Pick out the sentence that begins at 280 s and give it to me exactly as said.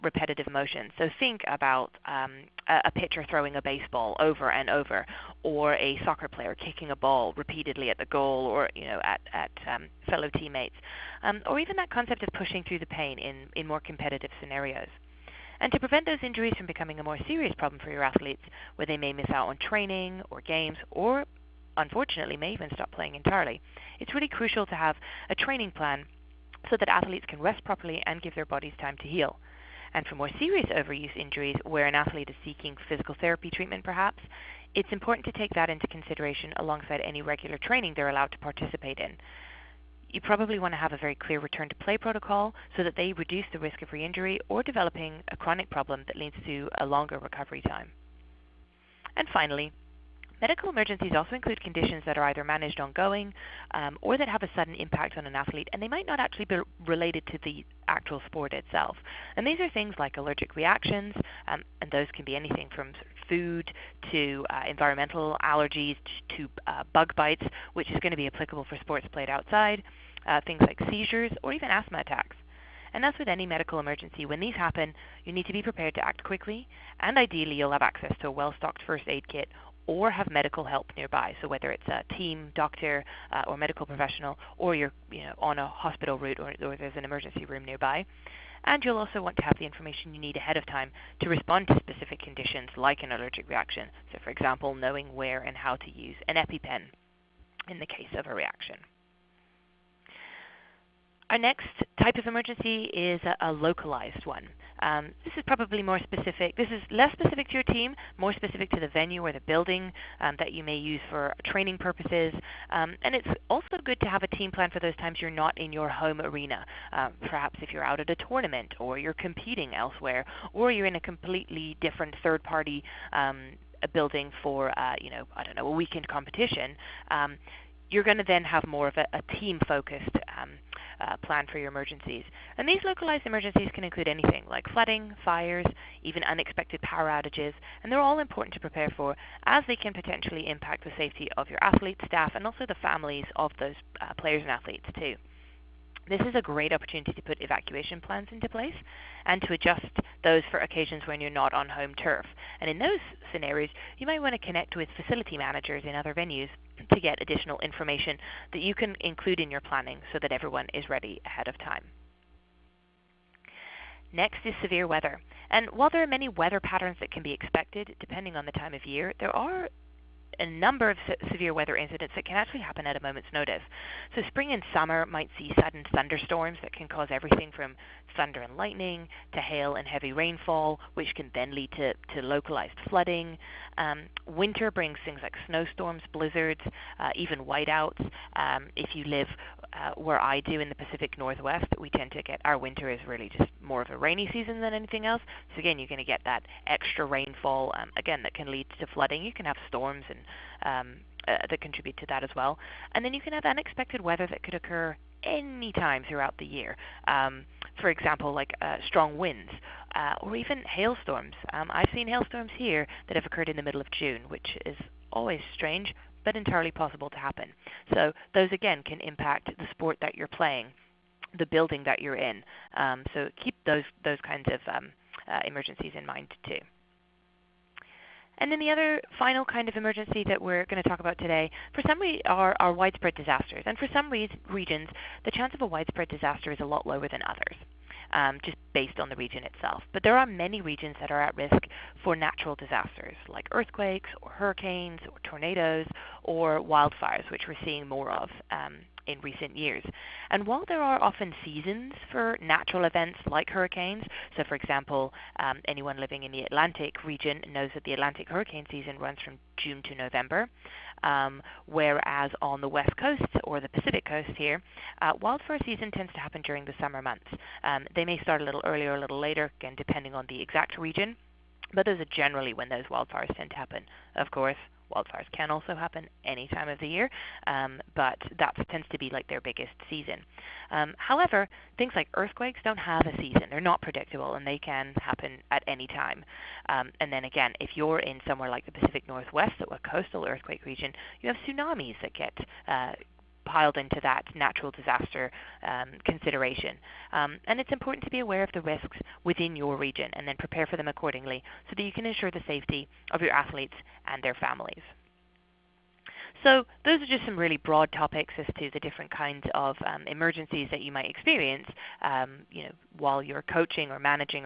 Um, however, things like earthquakes don't have a season.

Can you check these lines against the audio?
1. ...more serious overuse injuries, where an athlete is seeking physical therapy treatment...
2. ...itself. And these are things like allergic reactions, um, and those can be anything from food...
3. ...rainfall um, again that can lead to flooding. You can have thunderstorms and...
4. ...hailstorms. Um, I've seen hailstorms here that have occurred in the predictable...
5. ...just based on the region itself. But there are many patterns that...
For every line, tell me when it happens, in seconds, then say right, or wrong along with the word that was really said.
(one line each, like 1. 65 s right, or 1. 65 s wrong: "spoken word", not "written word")
1. 30 s right
2. 58 s right
3. 197 s wrong: "storms", not "thunderstorms"
4. 210 s wrong: "middle", not "predictable"
5. 238 s wrong: "regions", not "patterns".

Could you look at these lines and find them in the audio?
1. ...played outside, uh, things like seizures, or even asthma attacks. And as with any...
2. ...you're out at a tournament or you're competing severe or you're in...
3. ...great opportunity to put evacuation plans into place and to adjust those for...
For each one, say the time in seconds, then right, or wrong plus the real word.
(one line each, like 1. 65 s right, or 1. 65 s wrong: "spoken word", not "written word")
1. 69 s right
2. 117 s wrong: "elsewhere", not "severe"
3. 146 s right.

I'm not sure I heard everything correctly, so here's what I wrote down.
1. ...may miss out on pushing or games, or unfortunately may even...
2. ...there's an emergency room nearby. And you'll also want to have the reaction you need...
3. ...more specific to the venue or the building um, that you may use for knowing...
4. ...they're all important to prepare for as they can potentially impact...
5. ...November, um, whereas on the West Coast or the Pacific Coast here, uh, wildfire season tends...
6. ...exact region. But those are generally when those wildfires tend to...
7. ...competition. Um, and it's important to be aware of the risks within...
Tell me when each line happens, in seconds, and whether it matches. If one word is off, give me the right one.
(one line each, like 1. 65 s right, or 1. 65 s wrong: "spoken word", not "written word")
1. 18 s wrong: "training", not "pushing"
2. 86 s wrong: "information", not "reaction"
3. 108 s wrong: "training", not "knowing"
4. 137 s right
5. 259 s right
6. 270 s right
7. 296 s wrong: "consideration", not "competition".